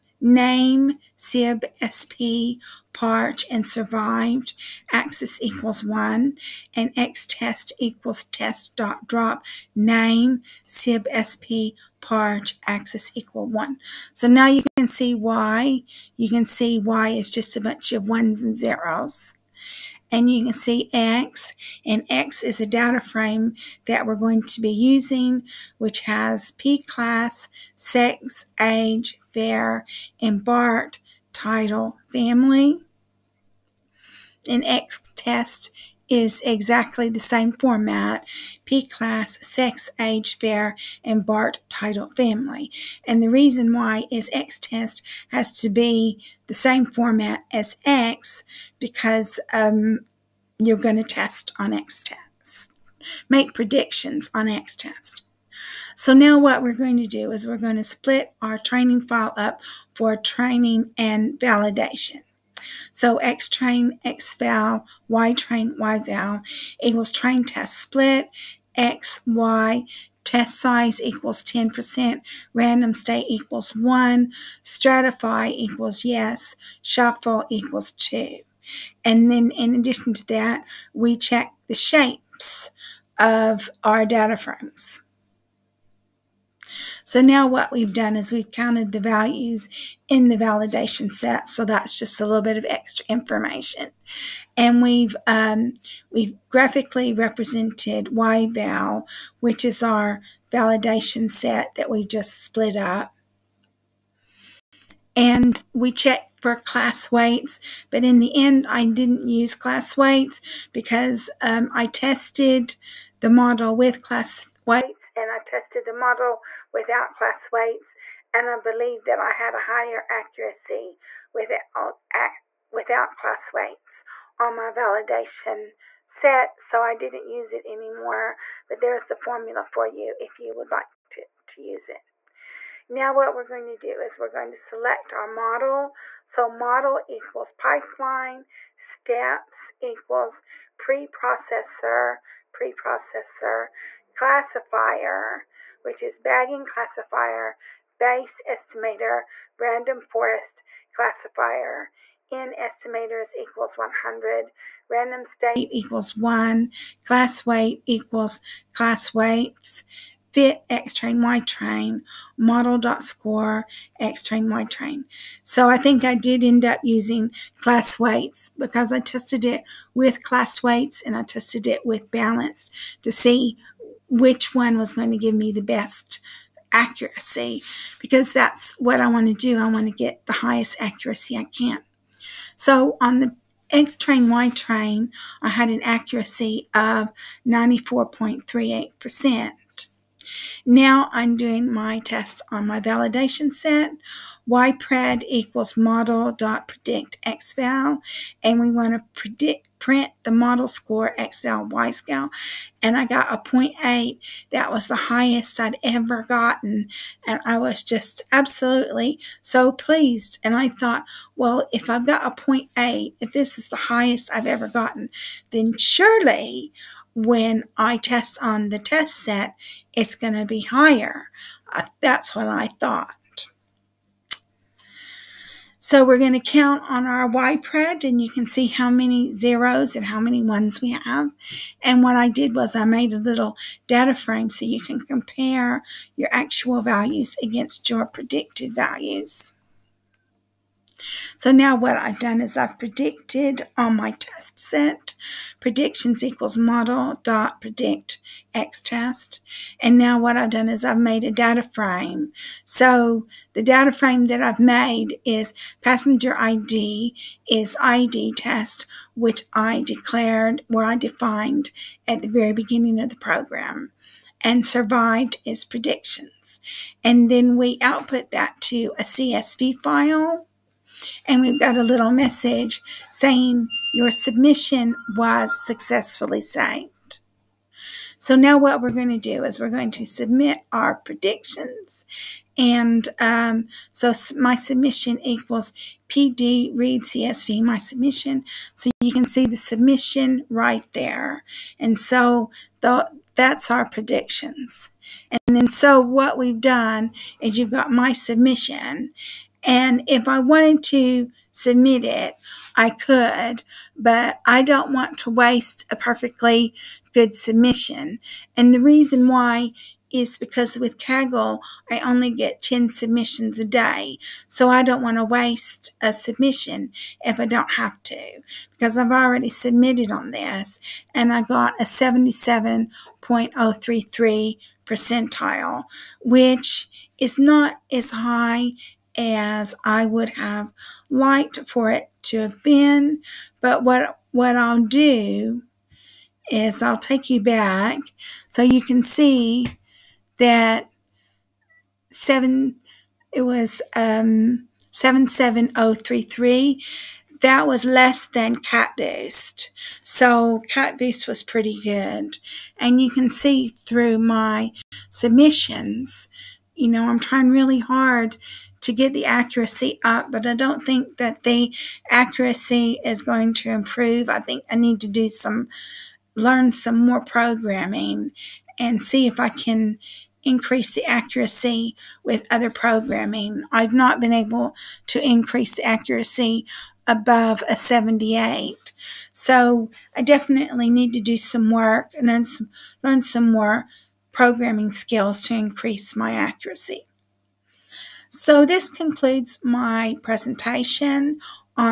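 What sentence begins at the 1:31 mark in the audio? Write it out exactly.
So that's just a little bit of extra information.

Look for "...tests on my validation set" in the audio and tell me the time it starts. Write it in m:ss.
3:11.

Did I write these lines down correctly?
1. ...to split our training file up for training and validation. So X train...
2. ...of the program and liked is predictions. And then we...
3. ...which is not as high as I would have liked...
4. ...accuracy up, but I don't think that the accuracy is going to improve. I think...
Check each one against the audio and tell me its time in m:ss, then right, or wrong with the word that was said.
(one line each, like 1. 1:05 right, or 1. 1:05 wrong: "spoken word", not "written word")
1. 0:57 right
2. 4:22 wrong: "survived", not "liked"
3. 5:26 right
4. 5:59 right.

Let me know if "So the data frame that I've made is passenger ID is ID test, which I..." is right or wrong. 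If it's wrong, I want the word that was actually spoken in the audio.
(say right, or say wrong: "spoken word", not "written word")
right.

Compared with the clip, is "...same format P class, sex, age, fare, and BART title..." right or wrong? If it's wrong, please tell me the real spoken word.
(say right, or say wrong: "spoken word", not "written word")
right.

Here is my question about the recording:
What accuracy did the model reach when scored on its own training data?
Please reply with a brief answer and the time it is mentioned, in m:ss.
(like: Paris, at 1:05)
94.38%, at 3:07.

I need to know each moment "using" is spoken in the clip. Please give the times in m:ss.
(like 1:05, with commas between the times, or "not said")
0:24, 2:46.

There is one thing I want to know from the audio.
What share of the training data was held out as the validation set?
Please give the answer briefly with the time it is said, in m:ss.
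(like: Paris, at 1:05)
10%, at 1:10.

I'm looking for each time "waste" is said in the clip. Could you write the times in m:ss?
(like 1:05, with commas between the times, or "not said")
5:05, 5:15.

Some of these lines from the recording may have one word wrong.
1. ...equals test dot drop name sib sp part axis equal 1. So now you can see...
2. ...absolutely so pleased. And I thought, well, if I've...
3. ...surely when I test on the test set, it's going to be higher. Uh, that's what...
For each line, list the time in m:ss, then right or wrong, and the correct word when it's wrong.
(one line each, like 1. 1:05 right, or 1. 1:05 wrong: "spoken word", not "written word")
1. 0:07 right
2. 3:28 right
3. 3:35 right.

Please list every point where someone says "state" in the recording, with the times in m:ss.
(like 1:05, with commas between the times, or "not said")
1:12, 2:35.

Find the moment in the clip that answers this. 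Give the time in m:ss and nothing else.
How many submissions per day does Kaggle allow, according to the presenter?
5:12.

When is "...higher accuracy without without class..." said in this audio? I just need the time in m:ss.
1:59.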